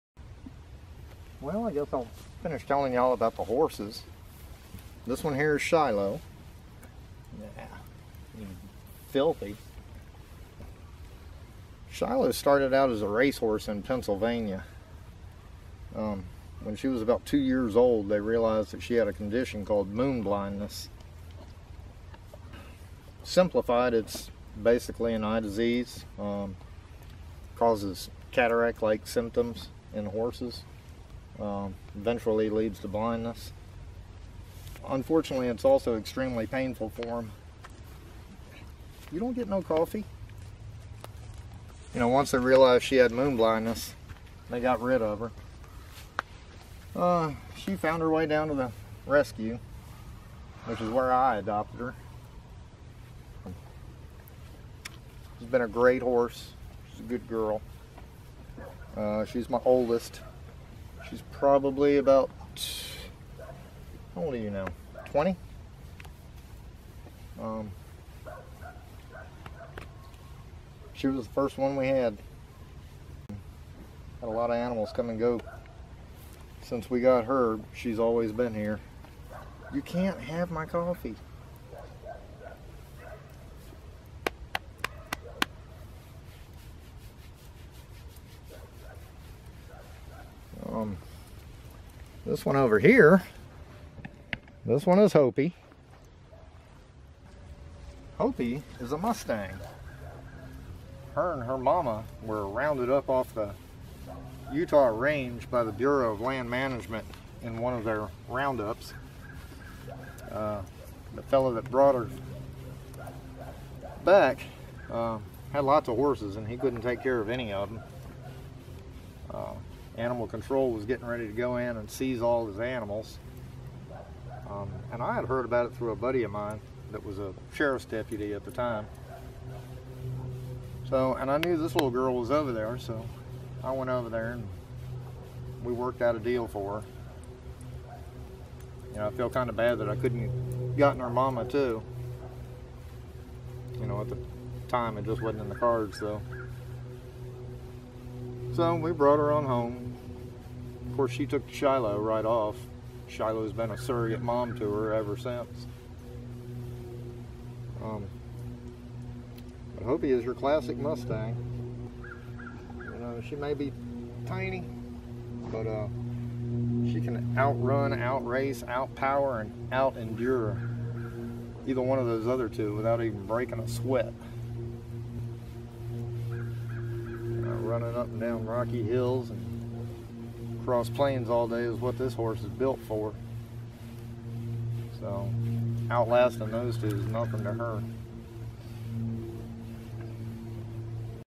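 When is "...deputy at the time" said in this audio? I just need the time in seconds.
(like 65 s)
127 s.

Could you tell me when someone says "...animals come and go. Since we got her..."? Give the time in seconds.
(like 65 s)
74 s.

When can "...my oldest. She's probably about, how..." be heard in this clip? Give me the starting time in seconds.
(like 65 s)
59 s.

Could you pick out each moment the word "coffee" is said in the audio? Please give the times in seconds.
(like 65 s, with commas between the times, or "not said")
39 s, 80 s.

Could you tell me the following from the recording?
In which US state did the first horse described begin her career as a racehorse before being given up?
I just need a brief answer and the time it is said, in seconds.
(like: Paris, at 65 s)
Pennsylvania, at 13 s.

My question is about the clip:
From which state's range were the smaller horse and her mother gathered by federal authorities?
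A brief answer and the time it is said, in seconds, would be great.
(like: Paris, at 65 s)
Utah, at 104 s.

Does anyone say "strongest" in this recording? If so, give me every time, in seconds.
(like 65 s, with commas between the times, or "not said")
not said.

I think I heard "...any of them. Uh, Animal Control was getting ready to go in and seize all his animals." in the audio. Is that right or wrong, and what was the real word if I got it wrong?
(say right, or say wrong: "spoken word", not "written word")
right.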